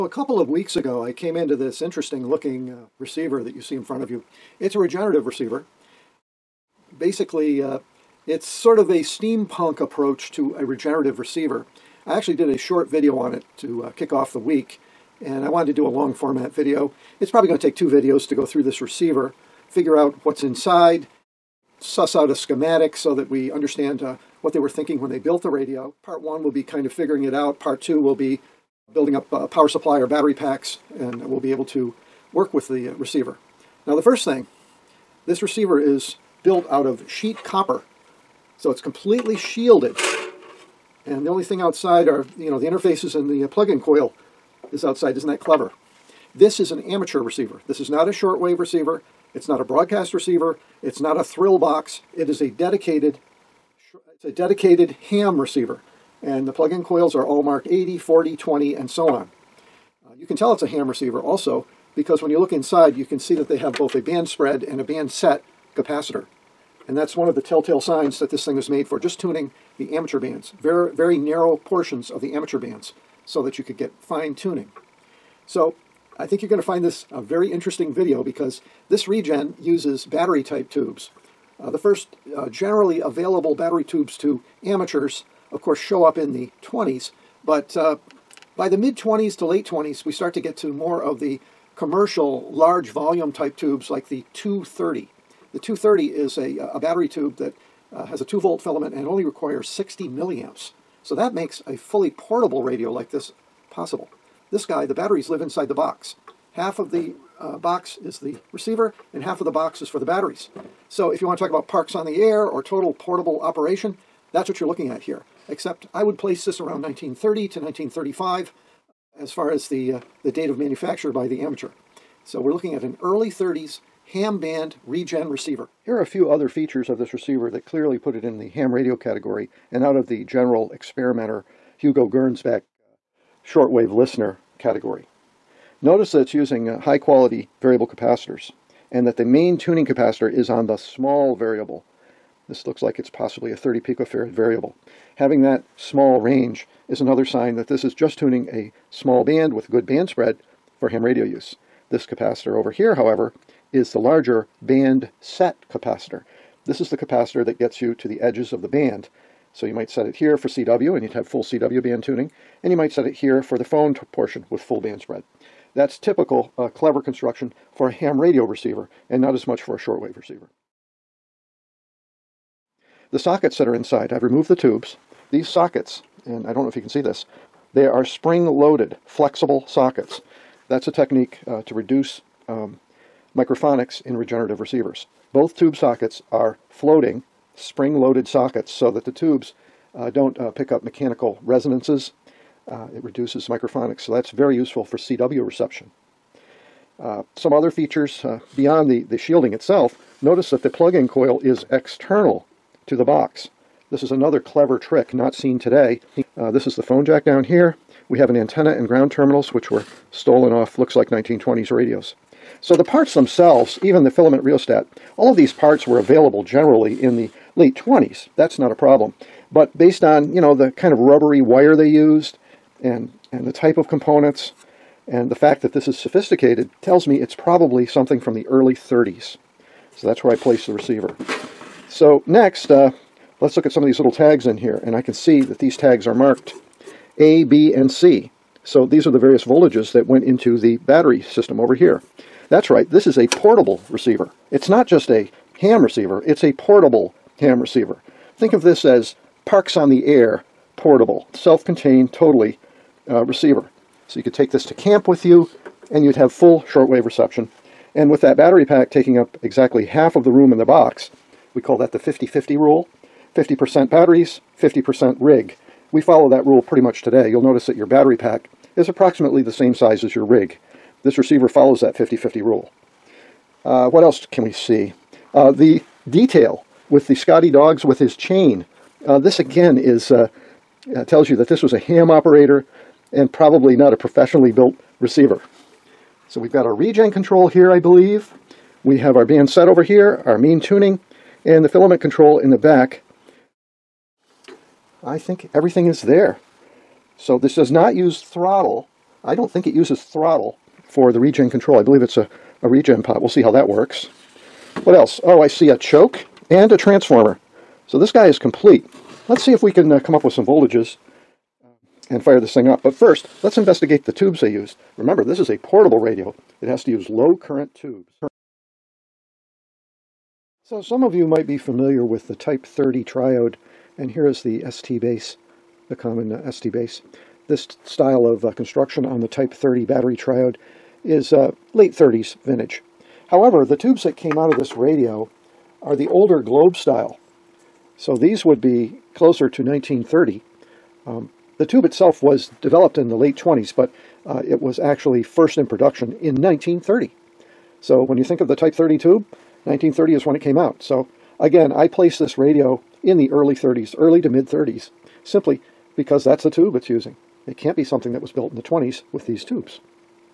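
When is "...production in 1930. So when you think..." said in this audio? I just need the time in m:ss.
5:45.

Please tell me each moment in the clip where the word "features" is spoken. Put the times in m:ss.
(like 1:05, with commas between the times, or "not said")
2:06, 3:17.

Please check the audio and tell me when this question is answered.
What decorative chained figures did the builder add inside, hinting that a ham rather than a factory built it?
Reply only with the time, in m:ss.
4:37.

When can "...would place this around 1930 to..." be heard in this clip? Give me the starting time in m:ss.
1:56.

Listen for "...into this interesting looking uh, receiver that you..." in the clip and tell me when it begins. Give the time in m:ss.
0:01.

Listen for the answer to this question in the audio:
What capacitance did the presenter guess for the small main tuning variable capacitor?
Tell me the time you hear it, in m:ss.
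2:23.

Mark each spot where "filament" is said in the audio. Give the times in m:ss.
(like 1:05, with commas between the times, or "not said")
1:38, 3:34, 4:51.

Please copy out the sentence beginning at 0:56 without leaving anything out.
And the plug-in coils are all marked 80, 40, 20, and so on.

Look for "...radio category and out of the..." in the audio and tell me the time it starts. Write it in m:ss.
2:08.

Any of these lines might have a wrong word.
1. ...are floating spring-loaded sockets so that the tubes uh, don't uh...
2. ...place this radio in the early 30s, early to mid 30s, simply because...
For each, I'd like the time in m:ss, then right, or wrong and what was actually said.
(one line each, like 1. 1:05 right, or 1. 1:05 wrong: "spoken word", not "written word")
1. 3:06 right
2. 5:51 right.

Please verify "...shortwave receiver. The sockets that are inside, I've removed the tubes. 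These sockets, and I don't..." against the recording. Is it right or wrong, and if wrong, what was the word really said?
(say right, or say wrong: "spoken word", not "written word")
right.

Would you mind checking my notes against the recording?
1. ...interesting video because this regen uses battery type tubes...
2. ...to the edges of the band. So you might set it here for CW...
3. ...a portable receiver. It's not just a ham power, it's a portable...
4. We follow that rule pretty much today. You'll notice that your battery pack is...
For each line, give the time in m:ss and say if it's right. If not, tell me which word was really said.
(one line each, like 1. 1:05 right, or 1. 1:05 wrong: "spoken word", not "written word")
1. 1:17 right
2. 2:37 right
3. 4:03 wrong: "receiver", not "power"
4. 4:25 right.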